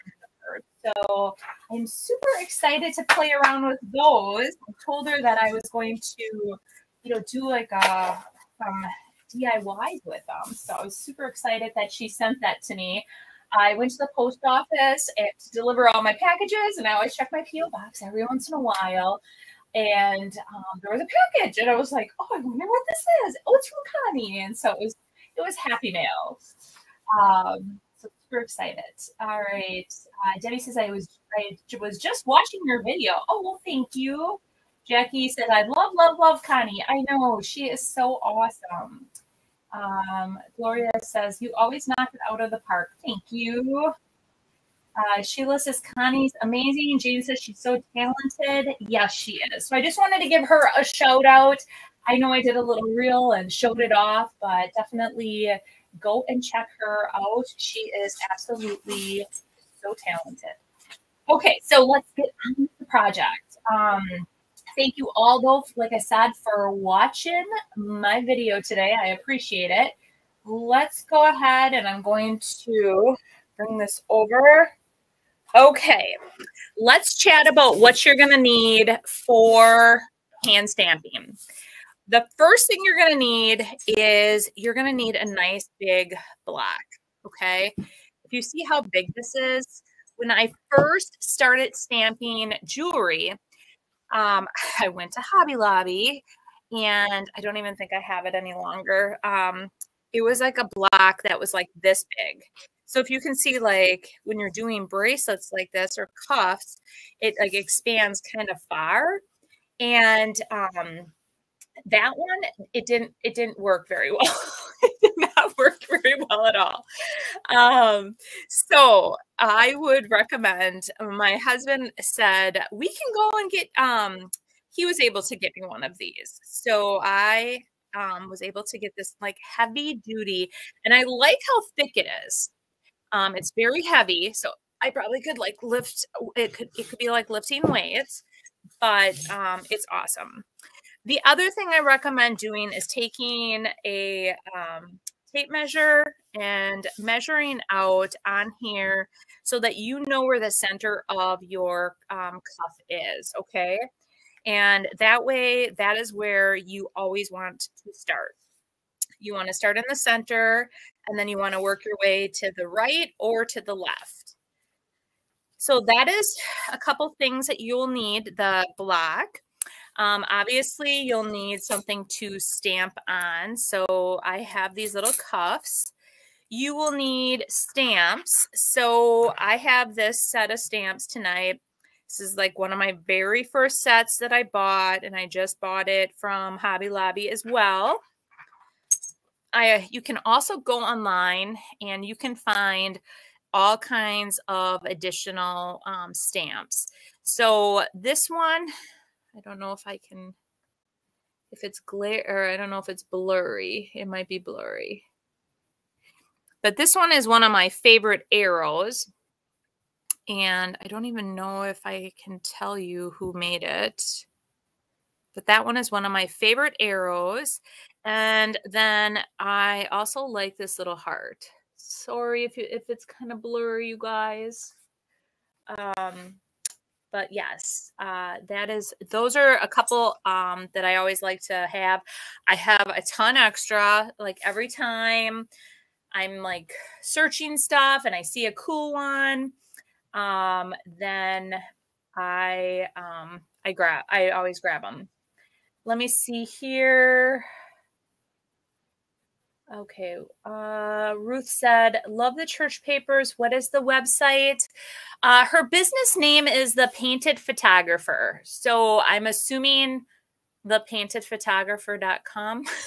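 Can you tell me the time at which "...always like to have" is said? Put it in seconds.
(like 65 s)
230 s.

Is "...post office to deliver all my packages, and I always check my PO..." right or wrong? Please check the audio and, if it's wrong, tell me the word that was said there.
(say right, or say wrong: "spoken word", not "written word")
right.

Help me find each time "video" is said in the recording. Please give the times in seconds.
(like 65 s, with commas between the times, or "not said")
32 s, 68 s.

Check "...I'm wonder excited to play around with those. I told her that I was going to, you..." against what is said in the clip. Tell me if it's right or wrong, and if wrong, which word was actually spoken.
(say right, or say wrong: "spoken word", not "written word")
wrong: "super", not "wonder".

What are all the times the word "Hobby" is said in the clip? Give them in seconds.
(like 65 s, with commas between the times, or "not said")
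95 s, 186 s.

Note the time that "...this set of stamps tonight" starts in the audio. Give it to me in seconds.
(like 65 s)
179 s.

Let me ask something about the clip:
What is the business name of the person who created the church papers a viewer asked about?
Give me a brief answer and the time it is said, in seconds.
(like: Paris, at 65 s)
The Painted Photographer, at 256 s.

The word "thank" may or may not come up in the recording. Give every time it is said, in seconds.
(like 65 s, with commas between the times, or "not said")
33 s, 43 s, 64 s.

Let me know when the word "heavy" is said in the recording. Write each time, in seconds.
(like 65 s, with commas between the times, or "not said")
129 s, 133 s.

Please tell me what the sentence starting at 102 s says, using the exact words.
So if you can see like when you're doing bracelets like this or cuffs, it like expands kind of far.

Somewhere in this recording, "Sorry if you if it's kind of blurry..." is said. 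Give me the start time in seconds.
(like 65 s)
221 s.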